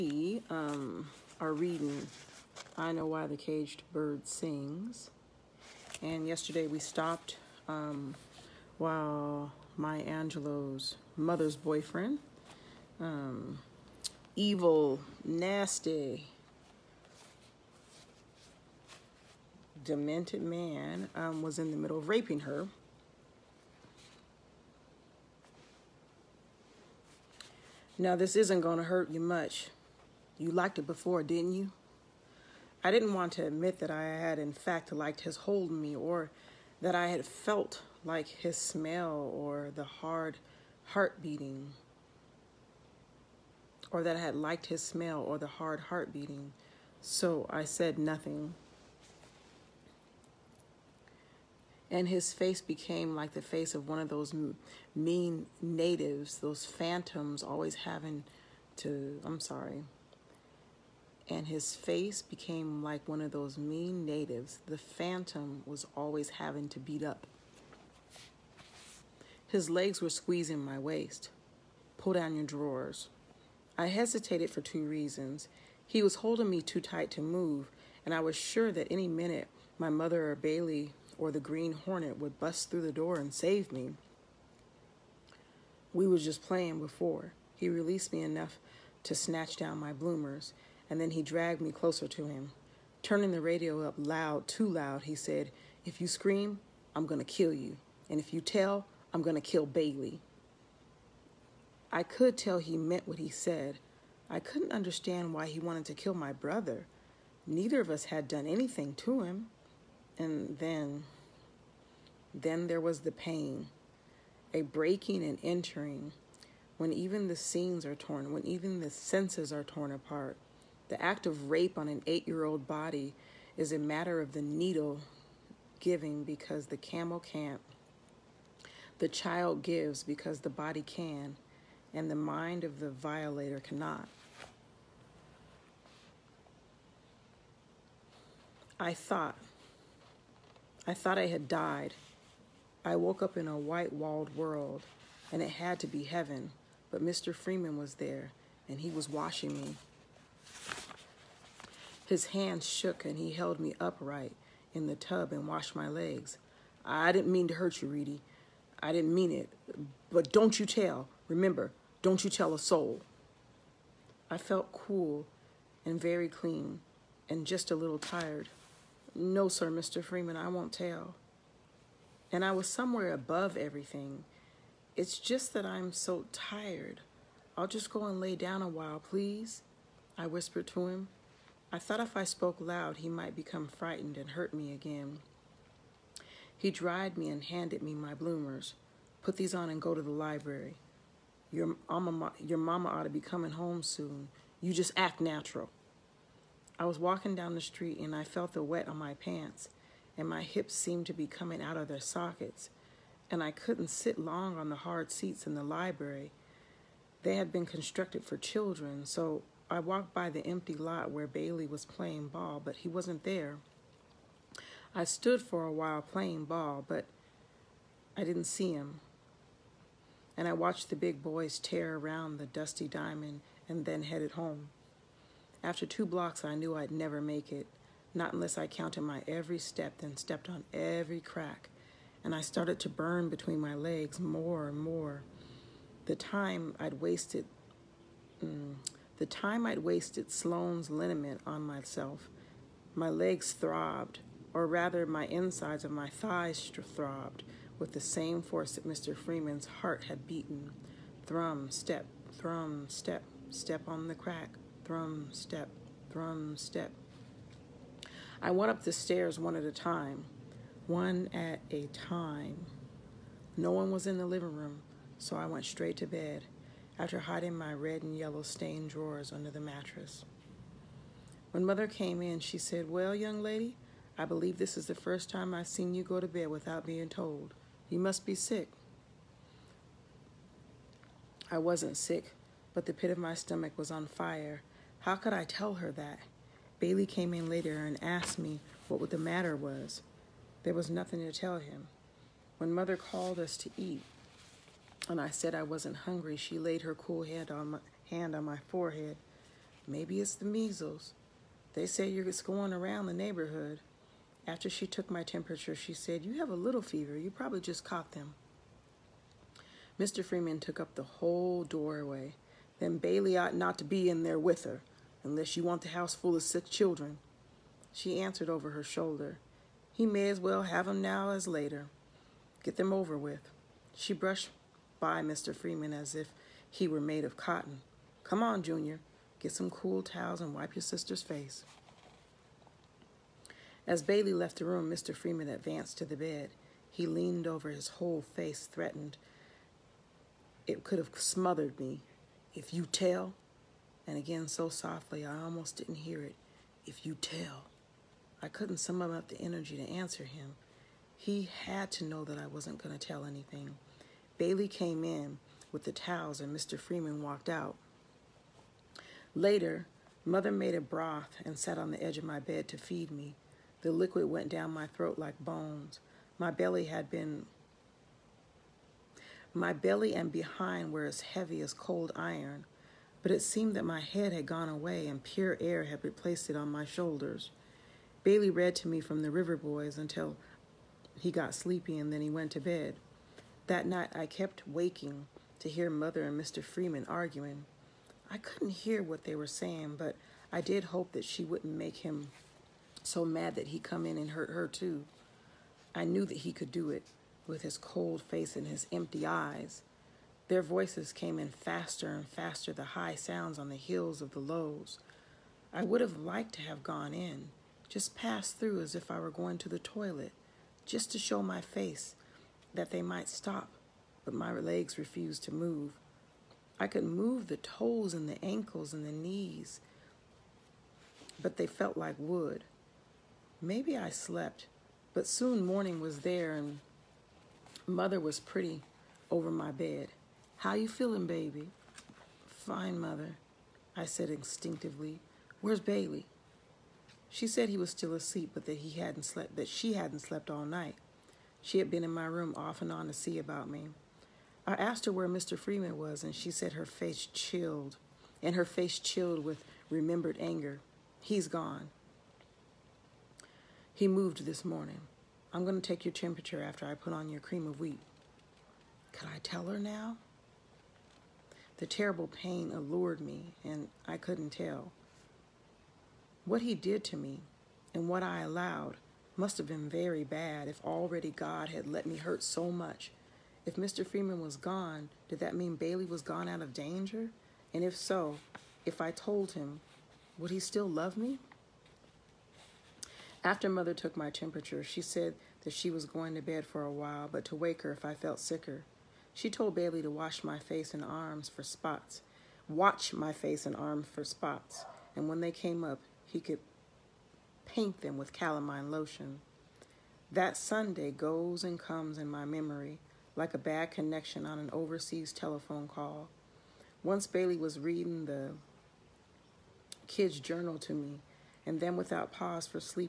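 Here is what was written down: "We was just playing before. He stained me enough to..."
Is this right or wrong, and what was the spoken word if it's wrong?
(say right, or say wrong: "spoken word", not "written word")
wrong: "released", not "stained".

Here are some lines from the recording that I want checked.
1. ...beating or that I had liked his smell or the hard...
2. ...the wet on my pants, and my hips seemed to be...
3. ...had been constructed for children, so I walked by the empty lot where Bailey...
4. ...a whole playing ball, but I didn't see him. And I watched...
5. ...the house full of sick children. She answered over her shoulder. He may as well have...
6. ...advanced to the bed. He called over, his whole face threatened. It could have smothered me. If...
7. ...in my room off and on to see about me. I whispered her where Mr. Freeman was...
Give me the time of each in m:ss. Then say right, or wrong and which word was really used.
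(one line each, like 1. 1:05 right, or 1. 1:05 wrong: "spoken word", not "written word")
1. 0:41 right
2. 3:18 right
3. 3:27 right
4. 3:35 wrong: "while", not "whole"
5. 5:15 right
6. 5:35 wrong: "leaned", not "called"
7. 7:22 wrong: "asked", not "whispered".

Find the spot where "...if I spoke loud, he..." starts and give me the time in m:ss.
3:01.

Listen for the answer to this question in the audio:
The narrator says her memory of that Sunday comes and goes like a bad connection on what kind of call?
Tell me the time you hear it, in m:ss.
8:24.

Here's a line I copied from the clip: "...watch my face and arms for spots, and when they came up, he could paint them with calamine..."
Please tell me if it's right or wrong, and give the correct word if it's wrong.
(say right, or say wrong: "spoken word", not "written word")
right.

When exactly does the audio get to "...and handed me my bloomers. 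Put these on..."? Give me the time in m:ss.
3:07.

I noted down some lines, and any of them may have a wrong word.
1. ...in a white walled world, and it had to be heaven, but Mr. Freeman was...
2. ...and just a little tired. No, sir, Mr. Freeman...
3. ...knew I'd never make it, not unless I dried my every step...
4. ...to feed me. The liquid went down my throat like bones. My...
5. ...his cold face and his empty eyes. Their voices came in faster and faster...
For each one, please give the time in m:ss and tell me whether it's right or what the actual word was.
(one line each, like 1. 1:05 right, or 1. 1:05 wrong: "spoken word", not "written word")
1. 2:23 right
2. 2:47 right
3. 3:46 wrong: "counted", not "dried"
4. 6:02 right
5. 6:37 right.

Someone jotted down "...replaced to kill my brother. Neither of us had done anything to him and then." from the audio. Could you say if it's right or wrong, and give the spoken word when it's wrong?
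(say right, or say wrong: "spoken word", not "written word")
wrong: "wanted", not "replaced".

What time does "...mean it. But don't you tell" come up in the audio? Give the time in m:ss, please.
2:39.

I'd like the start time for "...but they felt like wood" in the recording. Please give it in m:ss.
7:01.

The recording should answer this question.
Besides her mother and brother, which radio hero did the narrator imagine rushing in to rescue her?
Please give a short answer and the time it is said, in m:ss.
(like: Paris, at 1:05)
The Green Hornet, at 1:21.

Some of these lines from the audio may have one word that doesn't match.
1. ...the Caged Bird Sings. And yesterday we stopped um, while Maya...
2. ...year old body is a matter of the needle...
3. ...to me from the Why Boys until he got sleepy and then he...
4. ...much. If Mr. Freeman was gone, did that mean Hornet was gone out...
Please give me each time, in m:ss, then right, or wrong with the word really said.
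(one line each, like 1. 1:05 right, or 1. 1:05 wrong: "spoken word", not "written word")
1. 0:03 right
2. 2:02 right
3. 6:18 wrong: "Rover", not "Why"
4. 7:52 wrong: "Bailey", not "Hornet".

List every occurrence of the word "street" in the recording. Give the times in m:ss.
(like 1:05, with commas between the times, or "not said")
3:17.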